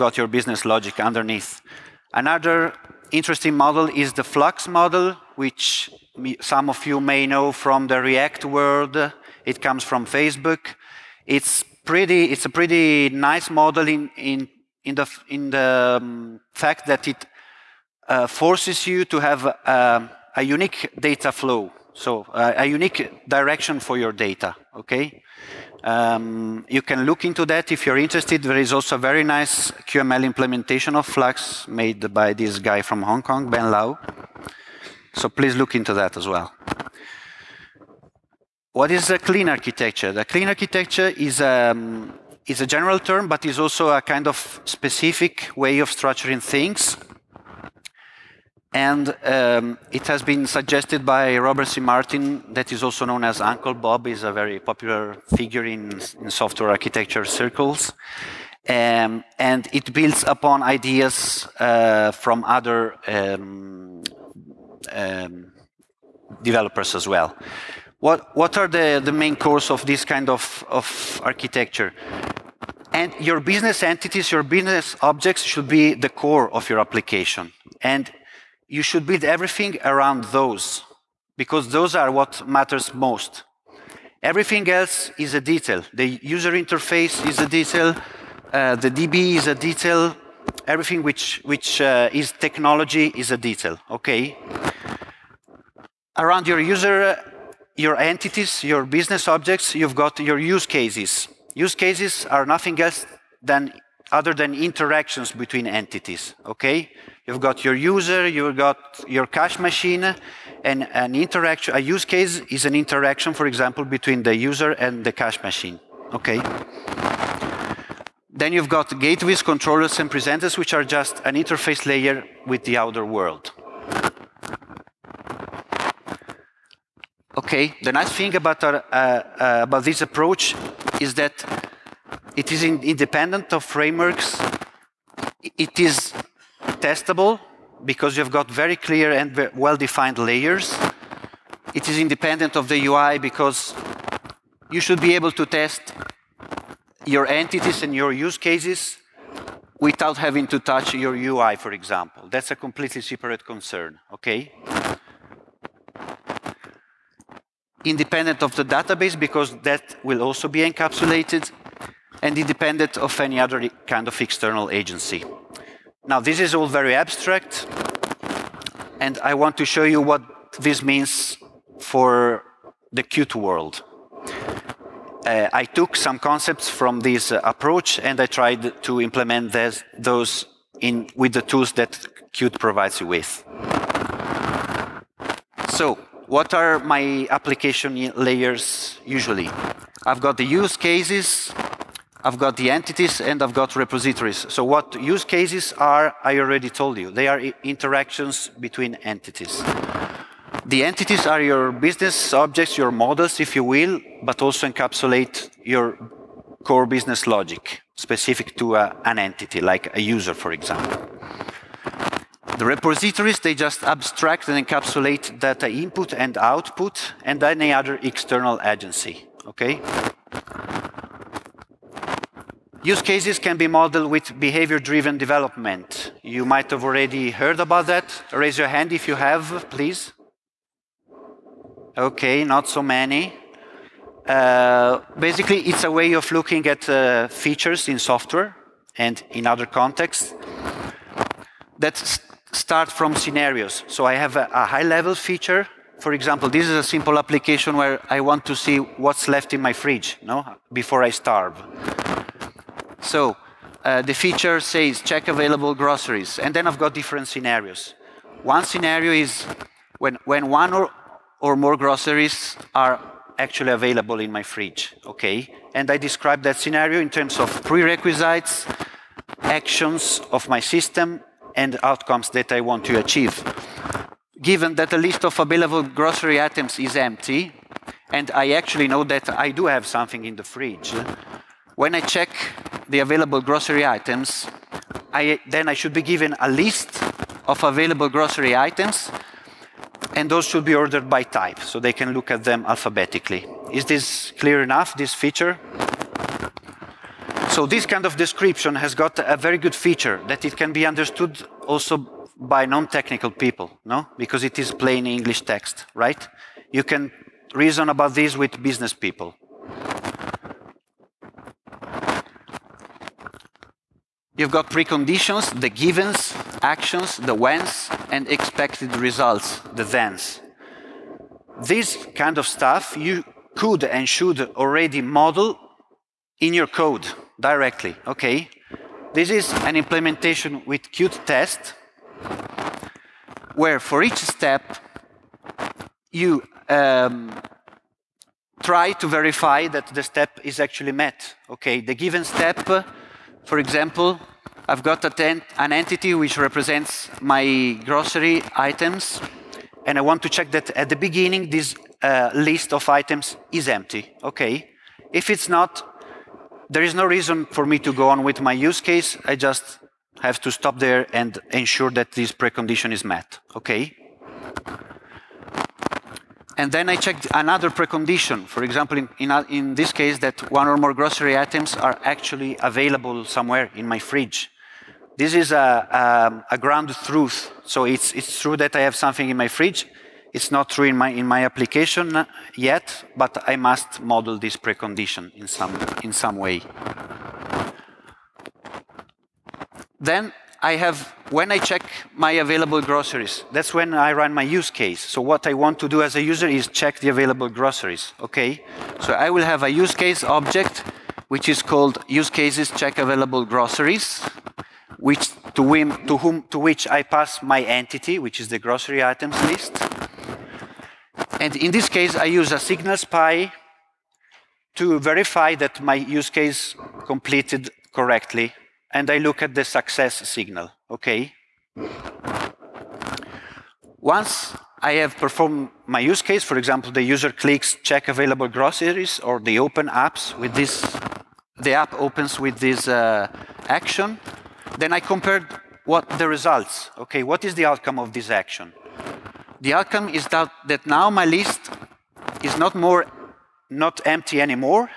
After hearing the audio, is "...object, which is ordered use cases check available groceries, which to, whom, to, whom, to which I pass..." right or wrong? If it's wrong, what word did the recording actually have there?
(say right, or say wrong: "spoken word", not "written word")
wrong: "called", not "ordered".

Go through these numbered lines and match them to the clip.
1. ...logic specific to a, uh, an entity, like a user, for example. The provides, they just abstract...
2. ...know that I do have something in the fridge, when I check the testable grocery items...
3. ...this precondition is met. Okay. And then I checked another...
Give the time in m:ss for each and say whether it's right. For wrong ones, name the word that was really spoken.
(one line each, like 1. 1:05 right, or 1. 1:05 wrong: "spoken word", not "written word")
1. 3:27 wrong: "repositories", not "provides"
2. 4:38 wrong: "available", not "testable"
3. 6:02 right.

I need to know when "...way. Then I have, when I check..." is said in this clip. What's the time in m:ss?
6:26.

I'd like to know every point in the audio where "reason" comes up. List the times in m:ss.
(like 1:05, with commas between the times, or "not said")
5:07, 5:57.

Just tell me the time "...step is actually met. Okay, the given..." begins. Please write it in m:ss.
5:40.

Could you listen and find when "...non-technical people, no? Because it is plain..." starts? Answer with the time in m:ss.
5:02.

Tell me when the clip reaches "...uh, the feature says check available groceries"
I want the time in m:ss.
4:13.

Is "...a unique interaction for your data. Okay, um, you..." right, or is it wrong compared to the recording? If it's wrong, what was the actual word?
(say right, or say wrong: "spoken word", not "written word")
wrong: "direction", not "interaction".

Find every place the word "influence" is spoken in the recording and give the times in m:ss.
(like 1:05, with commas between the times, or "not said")
not said.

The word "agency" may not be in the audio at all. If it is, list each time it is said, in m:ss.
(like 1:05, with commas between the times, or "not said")
2:44, 3:38.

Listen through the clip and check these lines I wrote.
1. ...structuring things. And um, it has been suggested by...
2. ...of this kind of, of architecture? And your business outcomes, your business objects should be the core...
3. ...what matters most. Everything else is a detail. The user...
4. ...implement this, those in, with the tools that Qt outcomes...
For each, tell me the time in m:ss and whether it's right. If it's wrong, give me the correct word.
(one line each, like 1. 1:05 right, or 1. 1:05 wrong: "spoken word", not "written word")
1. 0:45 right
2. 1:09 wrong: "entities", not "outcomes"
3. 1:22 right
4. 2:58 wrong: "provides", not "outcomes".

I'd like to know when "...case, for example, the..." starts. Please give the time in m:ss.
7:06.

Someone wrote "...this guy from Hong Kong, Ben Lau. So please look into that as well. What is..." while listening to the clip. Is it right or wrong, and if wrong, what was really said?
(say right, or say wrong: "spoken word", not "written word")
right.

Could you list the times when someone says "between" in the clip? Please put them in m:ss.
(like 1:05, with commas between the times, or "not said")
1:45, 1:53, 3:18.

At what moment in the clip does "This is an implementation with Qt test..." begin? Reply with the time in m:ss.
5:29.